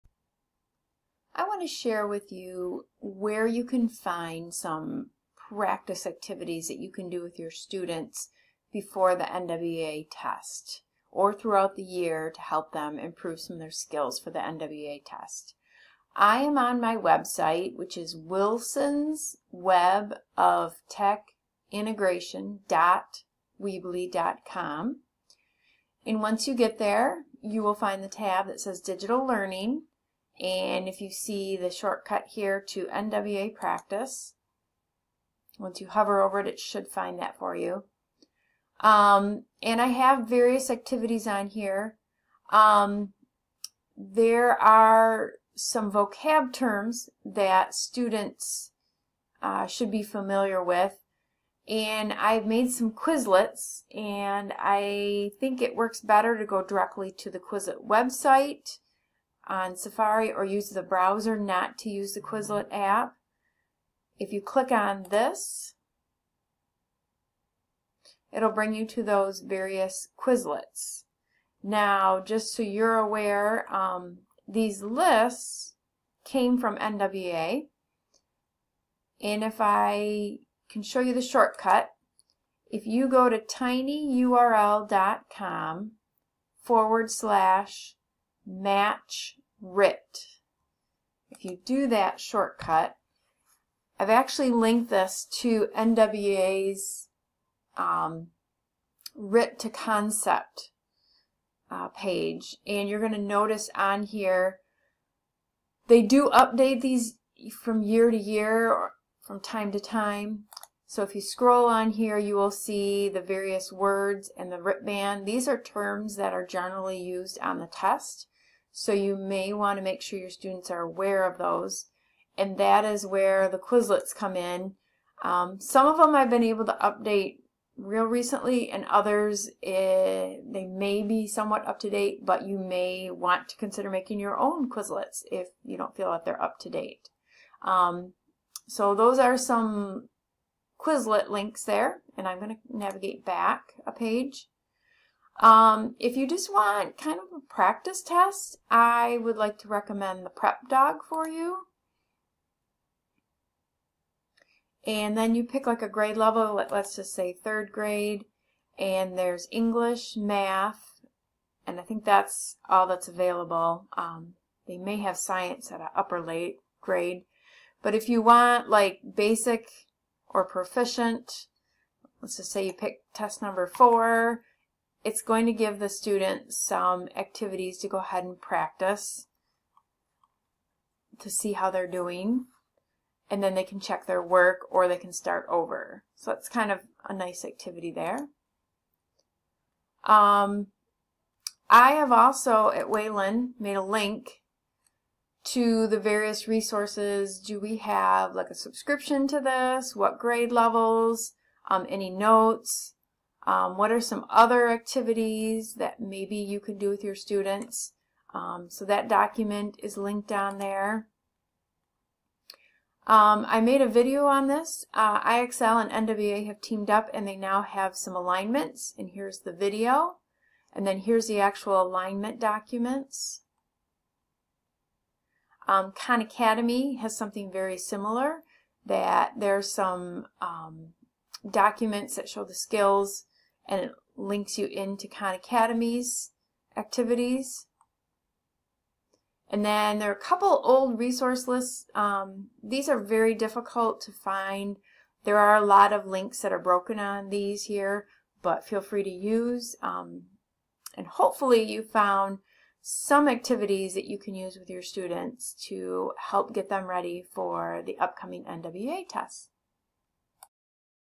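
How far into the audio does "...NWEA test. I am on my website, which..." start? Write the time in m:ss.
0:14.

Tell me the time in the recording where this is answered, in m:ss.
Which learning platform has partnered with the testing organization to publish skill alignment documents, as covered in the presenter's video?
3:35.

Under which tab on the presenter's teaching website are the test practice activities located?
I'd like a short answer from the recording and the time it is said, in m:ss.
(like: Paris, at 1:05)
Digital Learning, at 0:28.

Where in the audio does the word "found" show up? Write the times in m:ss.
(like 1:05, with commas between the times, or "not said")
4:11.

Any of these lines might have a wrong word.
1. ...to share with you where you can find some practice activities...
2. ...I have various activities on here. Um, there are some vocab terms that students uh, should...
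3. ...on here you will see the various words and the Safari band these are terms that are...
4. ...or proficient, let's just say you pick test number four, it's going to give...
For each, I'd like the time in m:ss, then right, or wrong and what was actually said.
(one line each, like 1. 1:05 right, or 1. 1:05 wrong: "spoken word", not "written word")
1. 0:01 right
2. 0:39 right
3. 1:51 wrong: "RIT", not "Safari"
4. 2:50 right.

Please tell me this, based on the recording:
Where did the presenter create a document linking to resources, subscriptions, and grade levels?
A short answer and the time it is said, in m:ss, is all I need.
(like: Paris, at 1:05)
Wayland, at 3:12.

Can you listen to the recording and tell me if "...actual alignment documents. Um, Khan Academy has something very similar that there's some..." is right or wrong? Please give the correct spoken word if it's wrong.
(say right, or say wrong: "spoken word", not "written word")
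right.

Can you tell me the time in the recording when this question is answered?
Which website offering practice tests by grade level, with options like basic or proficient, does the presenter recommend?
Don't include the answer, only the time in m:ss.
2:30.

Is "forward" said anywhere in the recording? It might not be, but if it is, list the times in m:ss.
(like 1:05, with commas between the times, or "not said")
1:26.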